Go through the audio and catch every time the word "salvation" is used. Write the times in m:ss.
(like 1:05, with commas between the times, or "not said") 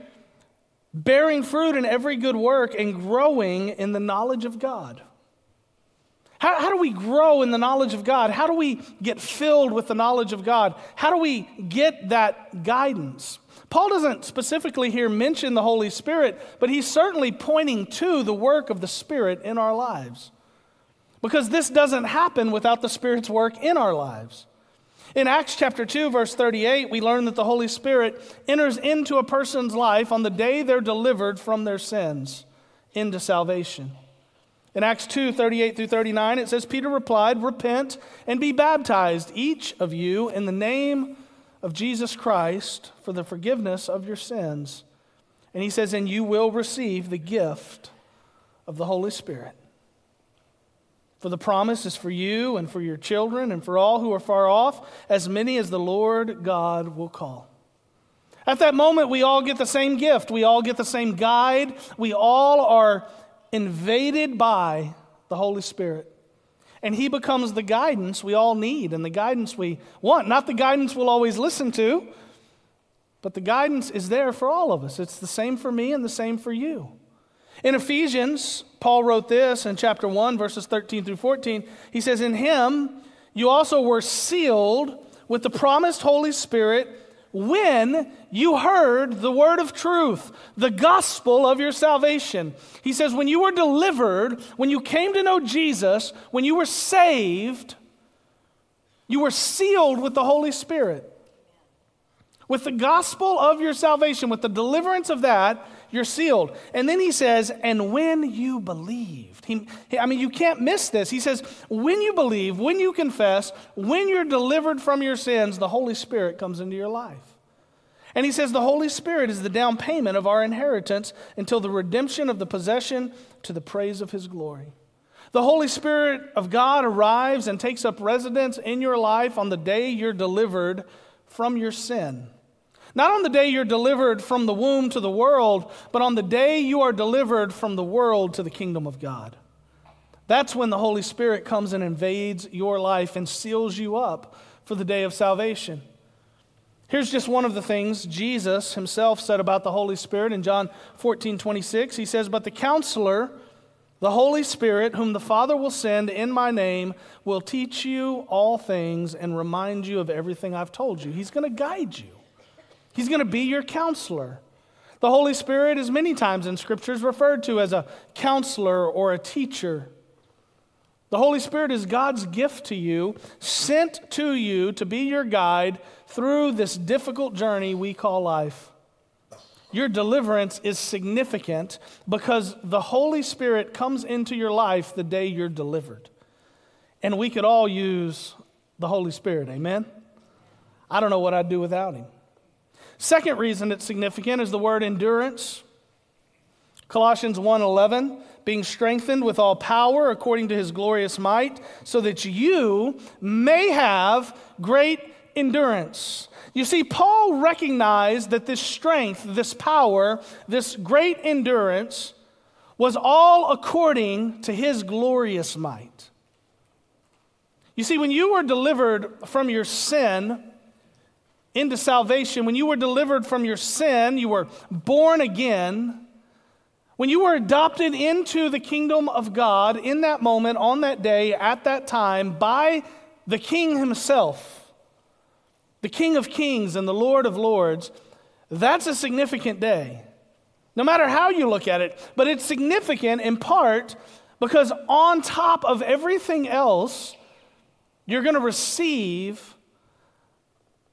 0:33, 1:31, 1:43, 2:25, 3:41.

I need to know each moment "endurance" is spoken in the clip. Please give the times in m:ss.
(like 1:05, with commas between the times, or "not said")
3:14, 3:25, 3:31.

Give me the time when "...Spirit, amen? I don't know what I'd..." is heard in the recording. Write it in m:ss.
3:09.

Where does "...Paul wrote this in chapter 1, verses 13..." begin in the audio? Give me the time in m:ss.
1:18.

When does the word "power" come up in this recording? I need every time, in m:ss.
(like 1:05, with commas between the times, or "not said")
3:19, 3:29.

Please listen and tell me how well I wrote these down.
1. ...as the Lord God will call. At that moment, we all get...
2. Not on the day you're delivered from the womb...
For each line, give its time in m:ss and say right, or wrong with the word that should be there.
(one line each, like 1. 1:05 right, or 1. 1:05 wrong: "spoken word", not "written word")
1. 0:55 right
2. 2:12 right.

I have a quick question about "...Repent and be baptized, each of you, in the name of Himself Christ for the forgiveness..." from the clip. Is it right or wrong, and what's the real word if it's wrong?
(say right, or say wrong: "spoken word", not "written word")
wrong: "Jesus", not "Himself".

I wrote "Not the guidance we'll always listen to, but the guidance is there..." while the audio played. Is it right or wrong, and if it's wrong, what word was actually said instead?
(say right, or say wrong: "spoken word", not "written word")
right.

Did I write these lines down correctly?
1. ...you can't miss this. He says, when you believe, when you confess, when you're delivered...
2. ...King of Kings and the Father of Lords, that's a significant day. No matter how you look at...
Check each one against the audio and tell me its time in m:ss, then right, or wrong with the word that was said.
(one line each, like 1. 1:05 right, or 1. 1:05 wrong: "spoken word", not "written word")
1. 1:50 right
2. 3:55 wrong: "Lord", not "Father".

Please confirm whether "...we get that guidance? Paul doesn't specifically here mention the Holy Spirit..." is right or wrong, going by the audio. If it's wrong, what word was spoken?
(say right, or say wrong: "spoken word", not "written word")
right.